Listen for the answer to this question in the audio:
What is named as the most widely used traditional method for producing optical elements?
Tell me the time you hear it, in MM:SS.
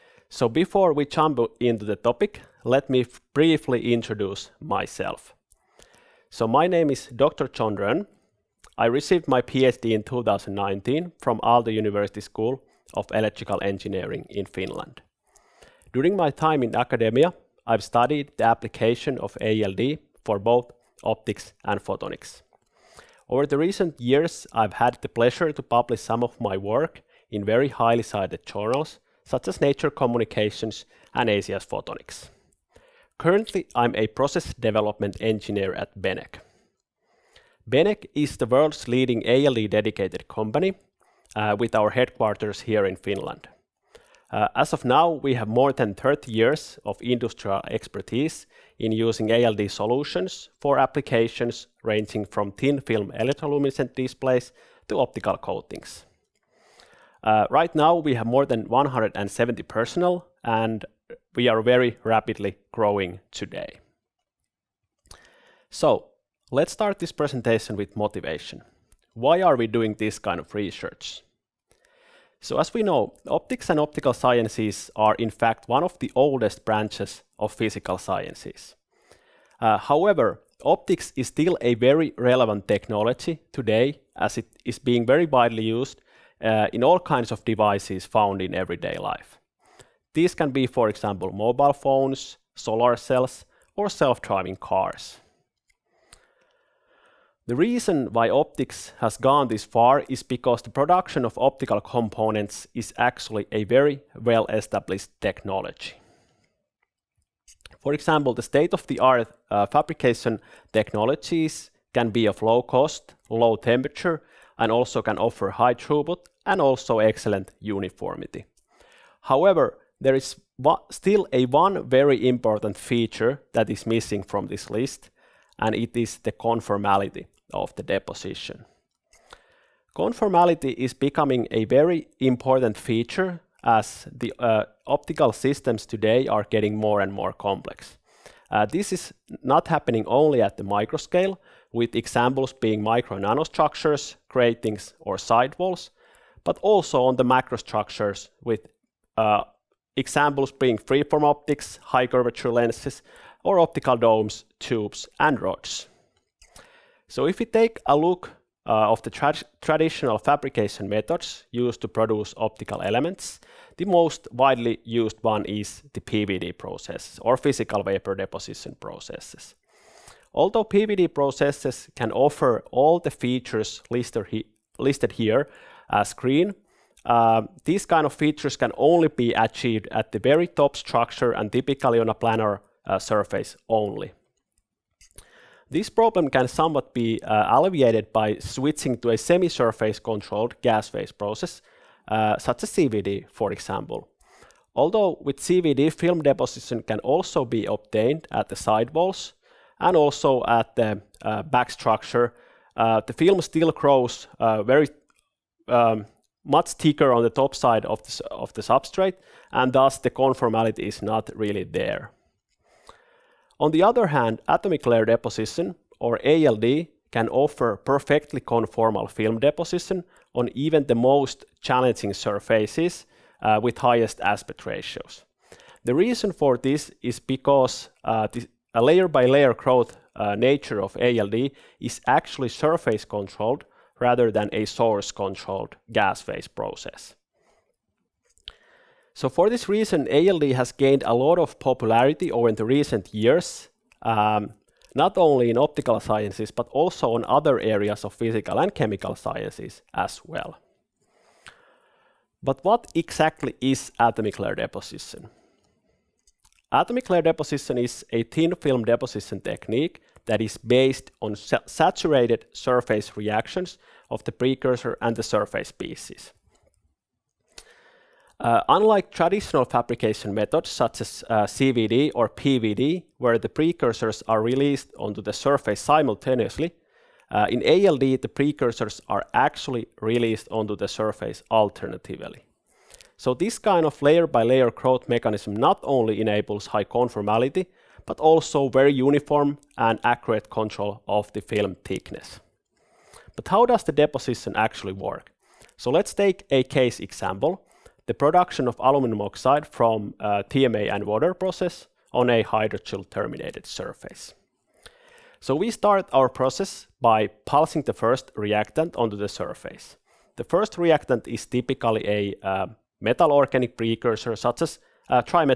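02:47.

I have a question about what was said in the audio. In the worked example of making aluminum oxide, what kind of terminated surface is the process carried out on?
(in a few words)
hydroxyl terminated.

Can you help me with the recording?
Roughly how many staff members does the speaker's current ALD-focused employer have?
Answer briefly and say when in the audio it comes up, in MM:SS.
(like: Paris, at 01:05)
more than 170, at 00:58.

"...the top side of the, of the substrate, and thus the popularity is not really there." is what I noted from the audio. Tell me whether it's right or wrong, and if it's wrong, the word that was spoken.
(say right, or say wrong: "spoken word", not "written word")
wrong: "conformality", not "popularity".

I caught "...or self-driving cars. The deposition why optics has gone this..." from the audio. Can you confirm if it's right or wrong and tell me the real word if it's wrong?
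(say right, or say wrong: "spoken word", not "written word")
wrong: "reason", not "deposition".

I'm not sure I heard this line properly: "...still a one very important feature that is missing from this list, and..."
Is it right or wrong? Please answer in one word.
right.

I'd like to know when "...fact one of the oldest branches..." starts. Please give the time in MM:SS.
01:15.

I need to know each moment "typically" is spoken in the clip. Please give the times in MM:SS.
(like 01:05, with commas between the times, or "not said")
03:01, 05:11.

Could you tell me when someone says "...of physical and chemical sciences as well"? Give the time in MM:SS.
04:08.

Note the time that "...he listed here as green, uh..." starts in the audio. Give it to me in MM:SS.
02:54.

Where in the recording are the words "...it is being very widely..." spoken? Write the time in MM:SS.
01:24.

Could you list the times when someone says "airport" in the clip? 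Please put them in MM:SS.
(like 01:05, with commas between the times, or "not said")
not said.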